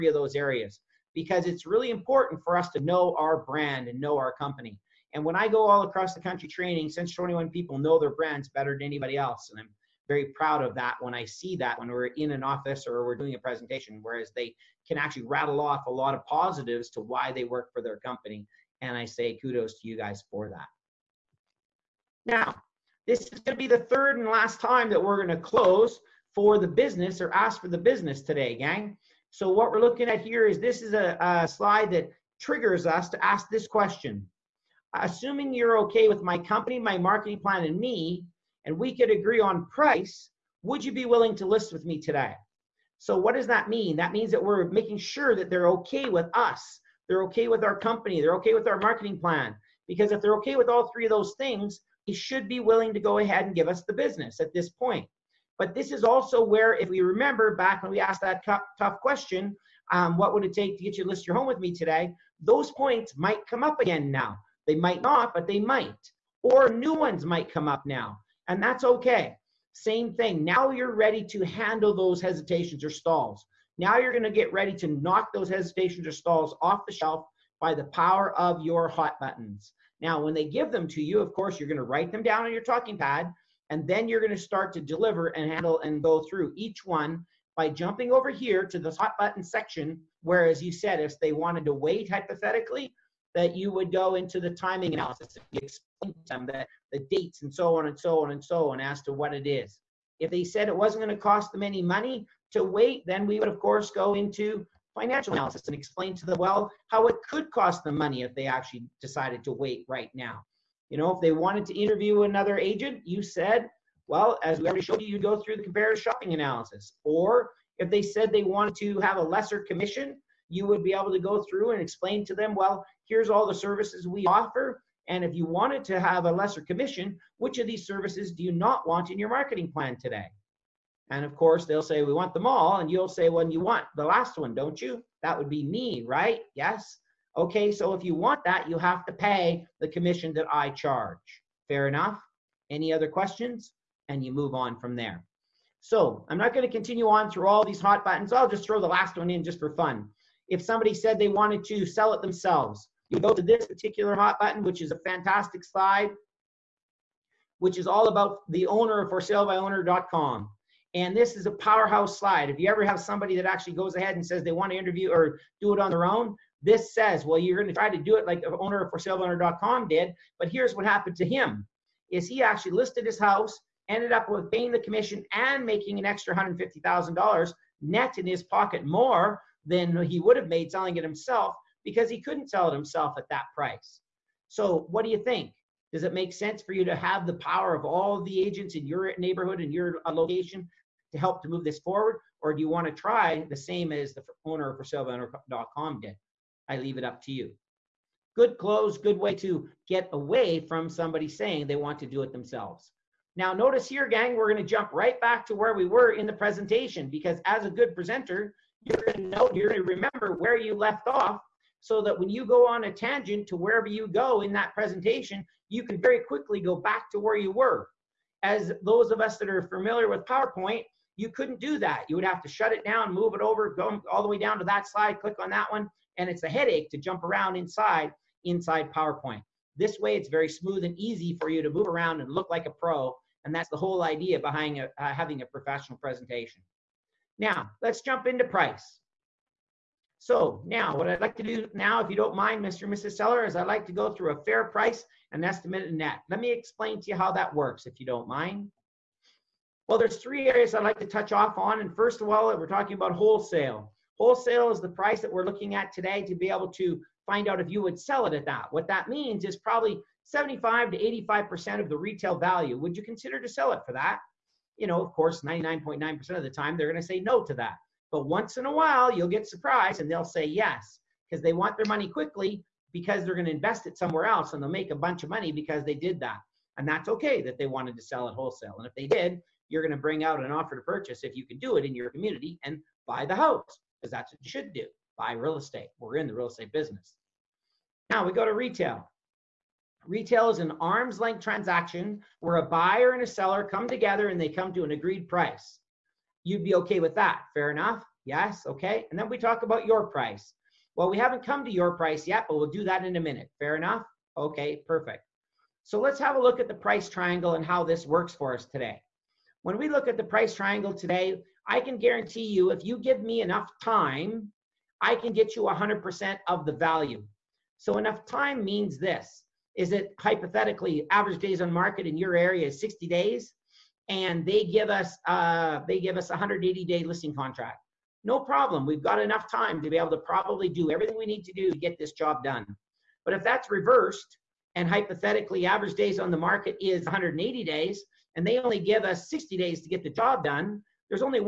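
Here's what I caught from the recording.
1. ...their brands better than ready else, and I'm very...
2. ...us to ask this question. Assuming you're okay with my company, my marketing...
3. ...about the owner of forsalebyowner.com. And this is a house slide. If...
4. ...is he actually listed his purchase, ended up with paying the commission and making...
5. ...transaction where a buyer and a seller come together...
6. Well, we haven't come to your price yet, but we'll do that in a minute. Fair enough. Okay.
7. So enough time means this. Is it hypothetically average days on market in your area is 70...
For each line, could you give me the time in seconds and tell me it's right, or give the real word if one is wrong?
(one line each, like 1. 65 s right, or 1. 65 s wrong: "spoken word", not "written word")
1. 7 s wrong: "anybody", not "ready"
2. 32 s right
3. 158 s wrong: "powerhouse", not "house"
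4. 172 s wrong: "house", not "purchase"
5. 291 s right
6. 300 s right
7. 317 s wrong: "60", not "70".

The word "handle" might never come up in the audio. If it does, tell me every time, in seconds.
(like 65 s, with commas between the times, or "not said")
71 s, 85 s.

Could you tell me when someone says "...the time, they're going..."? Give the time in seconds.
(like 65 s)
266 s.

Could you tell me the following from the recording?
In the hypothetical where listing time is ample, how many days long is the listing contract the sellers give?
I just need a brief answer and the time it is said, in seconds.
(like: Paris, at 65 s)
180, at 326 s.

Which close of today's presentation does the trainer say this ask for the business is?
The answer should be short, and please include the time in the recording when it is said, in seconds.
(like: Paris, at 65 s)
third, at 23 s.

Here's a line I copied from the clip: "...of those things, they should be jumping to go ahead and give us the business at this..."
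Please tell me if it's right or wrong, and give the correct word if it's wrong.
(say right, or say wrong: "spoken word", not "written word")
wrong: "willing", not "jumping".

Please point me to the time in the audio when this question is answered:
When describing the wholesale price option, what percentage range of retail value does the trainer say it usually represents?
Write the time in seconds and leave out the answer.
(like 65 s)
260 s.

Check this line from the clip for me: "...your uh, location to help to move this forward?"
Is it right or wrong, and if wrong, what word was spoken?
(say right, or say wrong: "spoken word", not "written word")
right.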